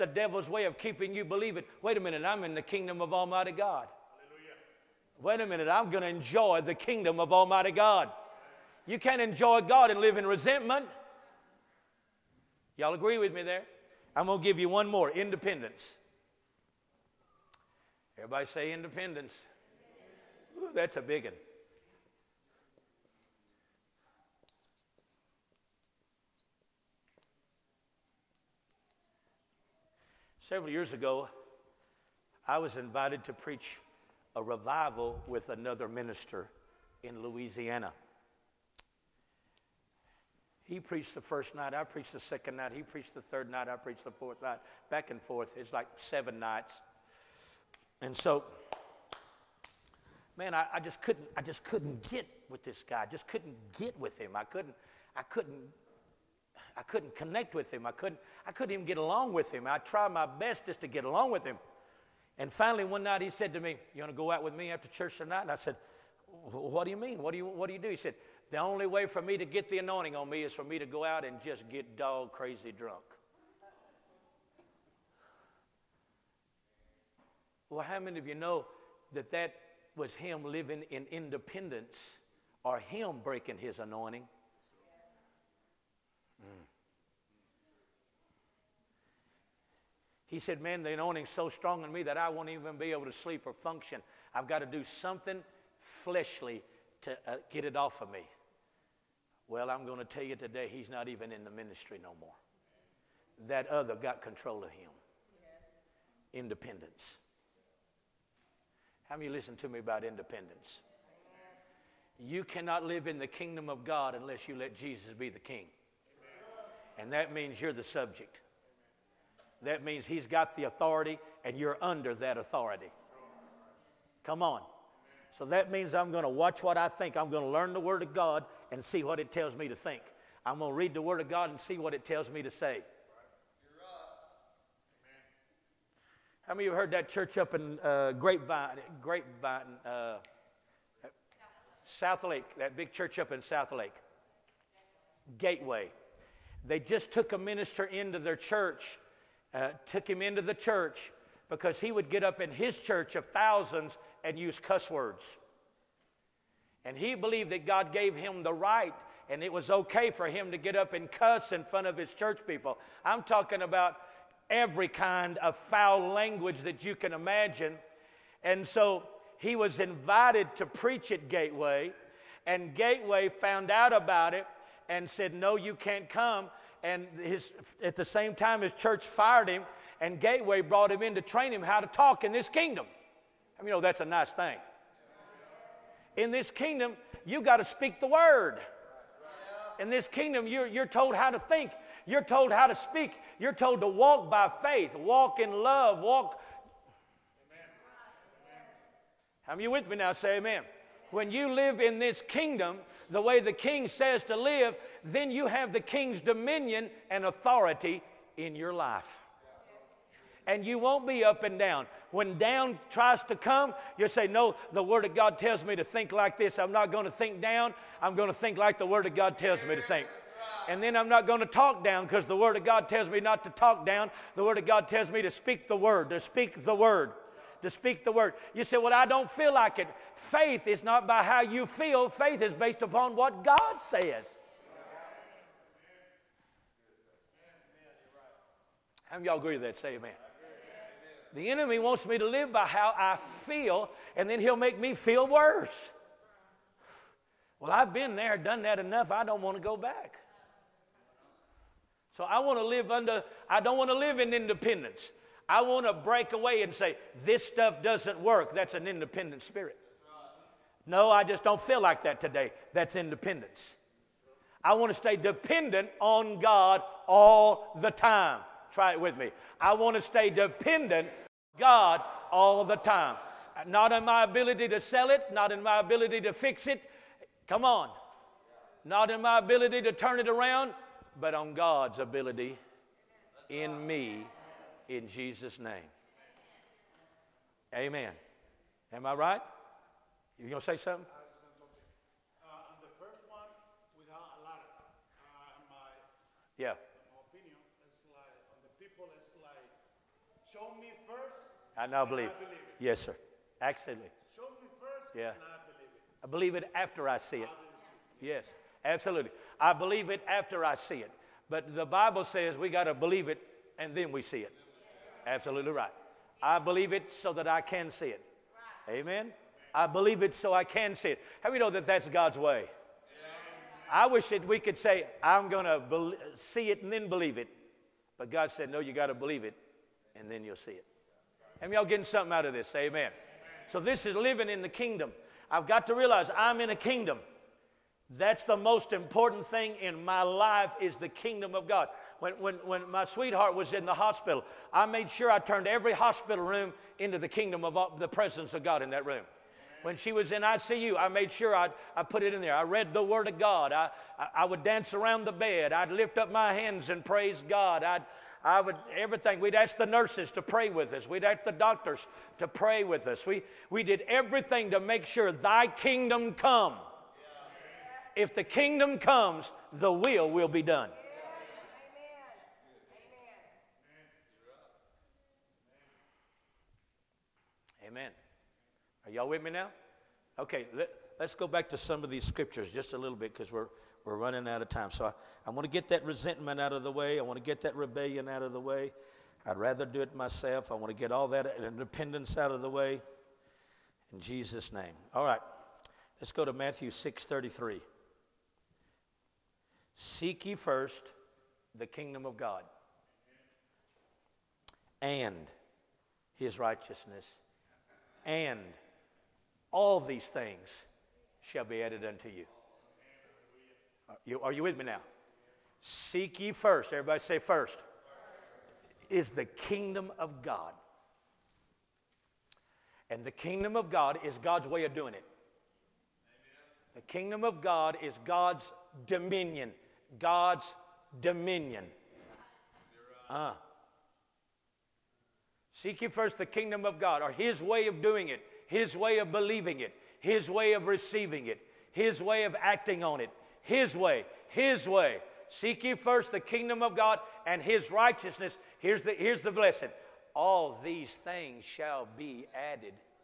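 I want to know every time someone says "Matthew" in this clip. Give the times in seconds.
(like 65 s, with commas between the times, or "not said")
396 s.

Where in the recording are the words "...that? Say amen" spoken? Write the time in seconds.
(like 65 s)
239 s.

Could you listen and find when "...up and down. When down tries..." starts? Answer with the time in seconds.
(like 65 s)
211 s.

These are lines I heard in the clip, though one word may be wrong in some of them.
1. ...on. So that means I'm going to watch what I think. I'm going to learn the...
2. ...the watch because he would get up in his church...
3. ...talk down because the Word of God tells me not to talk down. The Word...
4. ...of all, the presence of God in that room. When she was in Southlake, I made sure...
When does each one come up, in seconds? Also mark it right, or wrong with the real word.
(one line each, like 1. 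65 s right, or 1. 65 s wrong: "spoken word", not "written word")
1. 124 s right
2. 150 s wrong: "church", not "watch"
3. 221 s right
4. 347 s wrong: "ICU", not "Southlake".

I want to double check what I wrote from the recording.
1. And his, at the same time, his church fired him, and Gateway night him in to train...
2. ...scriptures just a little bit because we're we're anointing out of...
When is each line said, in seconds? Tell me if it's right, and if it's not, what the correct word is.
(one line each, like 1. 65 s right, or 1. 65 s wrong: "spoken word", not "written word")
1. 176 s wrong: "brought", not "night"
2. 382 s wrong: "running", not "anointing".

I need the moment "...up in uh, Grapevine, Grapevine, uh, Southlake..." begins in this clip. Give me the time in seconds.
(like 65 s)
137 s.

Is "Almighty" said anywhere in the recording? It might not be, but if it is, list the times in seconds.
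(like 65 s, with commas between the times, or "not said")
3 s, 7 s.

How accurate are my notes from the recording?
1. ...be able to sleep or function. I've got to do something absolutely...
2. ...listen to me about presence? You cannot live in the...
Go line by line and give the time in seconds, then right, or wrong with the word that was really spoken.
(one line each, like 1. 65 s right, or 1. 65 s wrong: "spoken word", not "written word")
1. 92 s wrong: "fleshly", not "absolutely"
2. 109 s wrong: "independence", not "presence".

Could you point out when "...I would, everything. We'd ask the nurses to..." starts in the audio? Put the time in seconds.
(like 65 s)
358 s.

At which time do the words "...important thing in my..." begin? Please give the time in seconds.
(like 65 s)
338 s.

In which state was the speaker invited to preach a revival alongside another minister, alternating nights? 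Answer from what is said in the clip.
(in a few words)
Louisiana.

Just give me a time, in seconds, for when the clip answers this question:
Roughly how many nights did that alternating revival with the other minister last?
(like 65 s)
45 s.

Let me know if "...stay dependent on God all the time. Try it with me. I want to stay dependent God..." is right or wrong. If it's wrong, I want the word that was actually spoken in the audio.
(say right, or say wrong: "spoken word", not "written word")
right.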